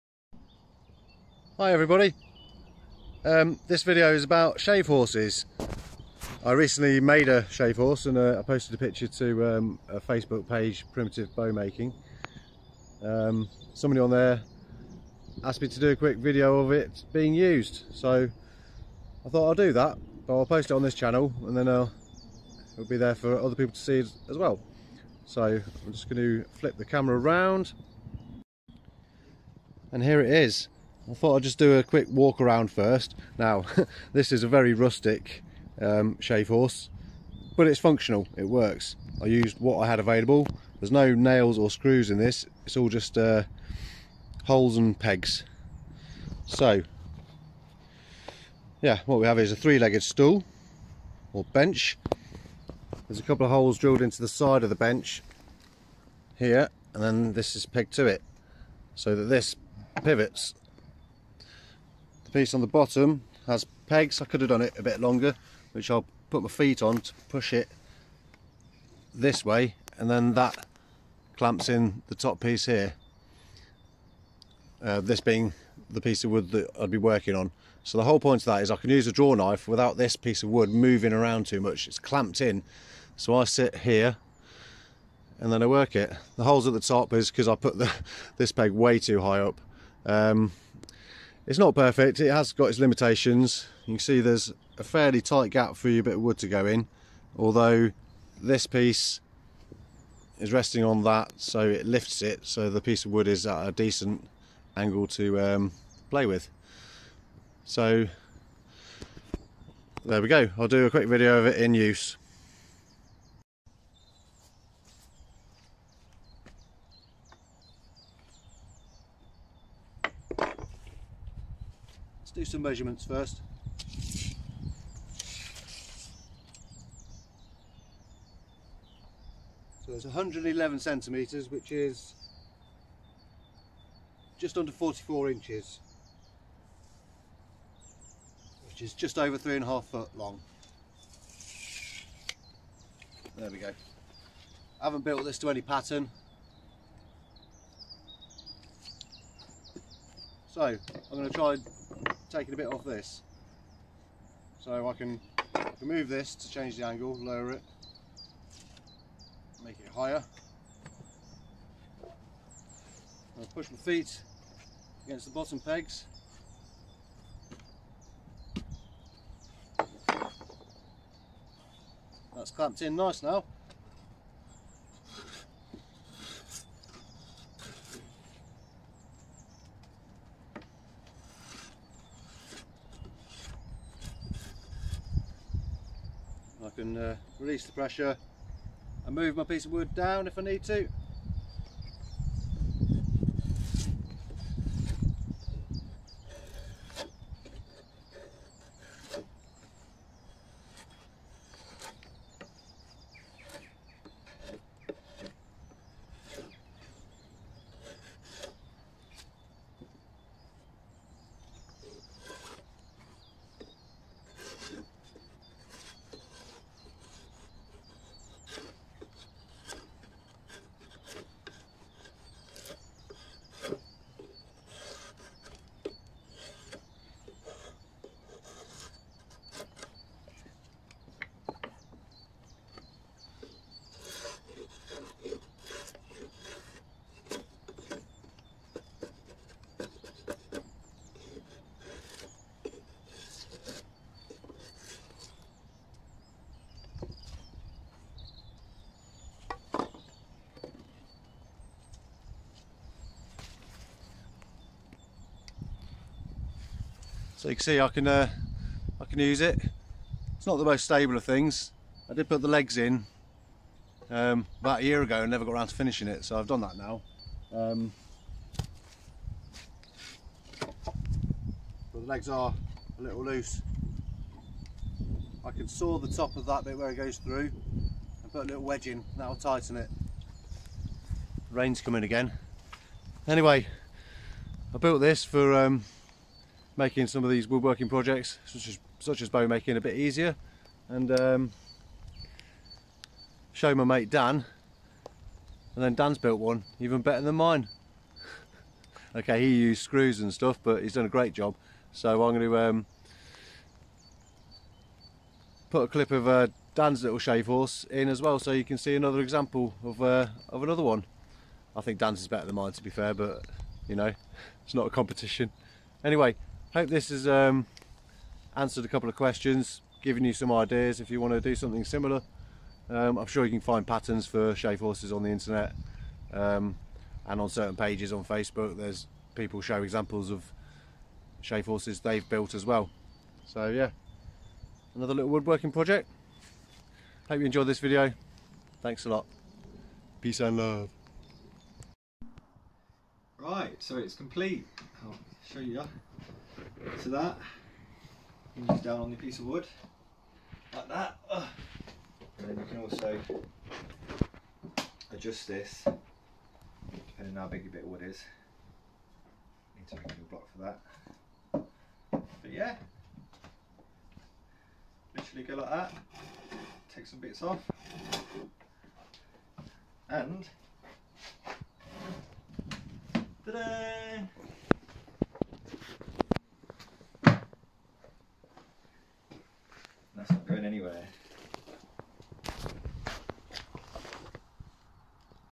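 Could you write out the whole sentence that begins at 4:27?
Um, but the legs are a little loose.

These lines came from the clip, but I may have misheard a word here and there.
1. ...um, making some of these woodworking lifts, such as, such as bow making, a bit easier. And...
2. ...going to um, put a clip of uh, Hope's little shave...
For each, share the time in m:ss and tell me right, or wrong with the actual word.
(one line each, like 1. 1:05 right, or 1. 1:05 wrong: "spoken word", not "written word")
1. 4:45 wrong: "projects", not "lifts"
2. 5:02 wrong: "Dan", not "Hope".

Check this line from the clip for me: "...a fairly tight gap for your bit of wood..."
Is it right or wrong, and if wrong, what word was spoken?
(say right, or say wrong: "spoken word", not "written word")
right.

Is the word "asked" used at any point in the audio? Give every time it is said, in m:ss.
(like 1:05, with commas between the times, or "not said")
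0:15.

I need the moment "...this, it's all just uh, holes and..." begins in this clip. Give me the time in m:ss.
0:42.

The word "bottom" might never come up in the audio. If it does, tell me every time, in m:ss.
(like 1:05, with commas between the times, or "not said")
1:02, 2:45.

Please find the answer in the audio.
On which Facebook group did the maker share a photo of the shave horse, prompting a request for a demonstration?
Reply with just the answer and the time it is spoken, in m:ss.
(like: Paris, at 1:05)
Primitive Bow Making, at 0:10.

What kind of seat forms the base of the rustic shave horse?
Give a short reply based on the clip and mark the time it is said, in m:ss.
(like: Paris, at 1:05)
three-legged stool, at 0:49.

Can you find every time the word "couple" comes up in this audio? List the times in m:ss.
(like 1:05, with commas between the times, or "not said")
0:53, 5:18.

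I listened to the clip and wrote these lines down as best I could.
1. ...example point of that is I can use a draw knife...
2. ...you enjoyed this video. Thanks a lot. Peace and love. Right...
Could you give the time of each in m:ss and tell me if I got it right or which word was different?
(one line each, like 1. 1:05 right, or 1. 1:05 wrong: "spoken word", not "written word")
1. 1:18 wrong: "whole", not "example"
2. 5:37 right.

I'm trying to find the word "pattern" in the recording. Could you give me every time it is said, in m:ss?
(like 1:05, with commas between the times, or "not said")
2:25, 5:23.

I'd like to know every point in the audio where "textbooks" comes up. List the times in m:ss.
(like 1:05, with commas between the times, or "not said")
not said.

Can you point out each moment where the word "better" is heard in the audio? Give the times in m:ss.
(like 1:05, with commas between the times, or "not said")
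4:57, 5:12.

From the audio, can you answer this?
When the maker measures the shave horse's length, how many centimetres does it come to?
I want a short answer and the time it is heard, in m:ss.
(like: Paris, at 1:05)
111 centimetres, at 2:10.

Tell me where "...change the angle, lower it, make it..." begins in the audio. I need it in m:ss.
2:36.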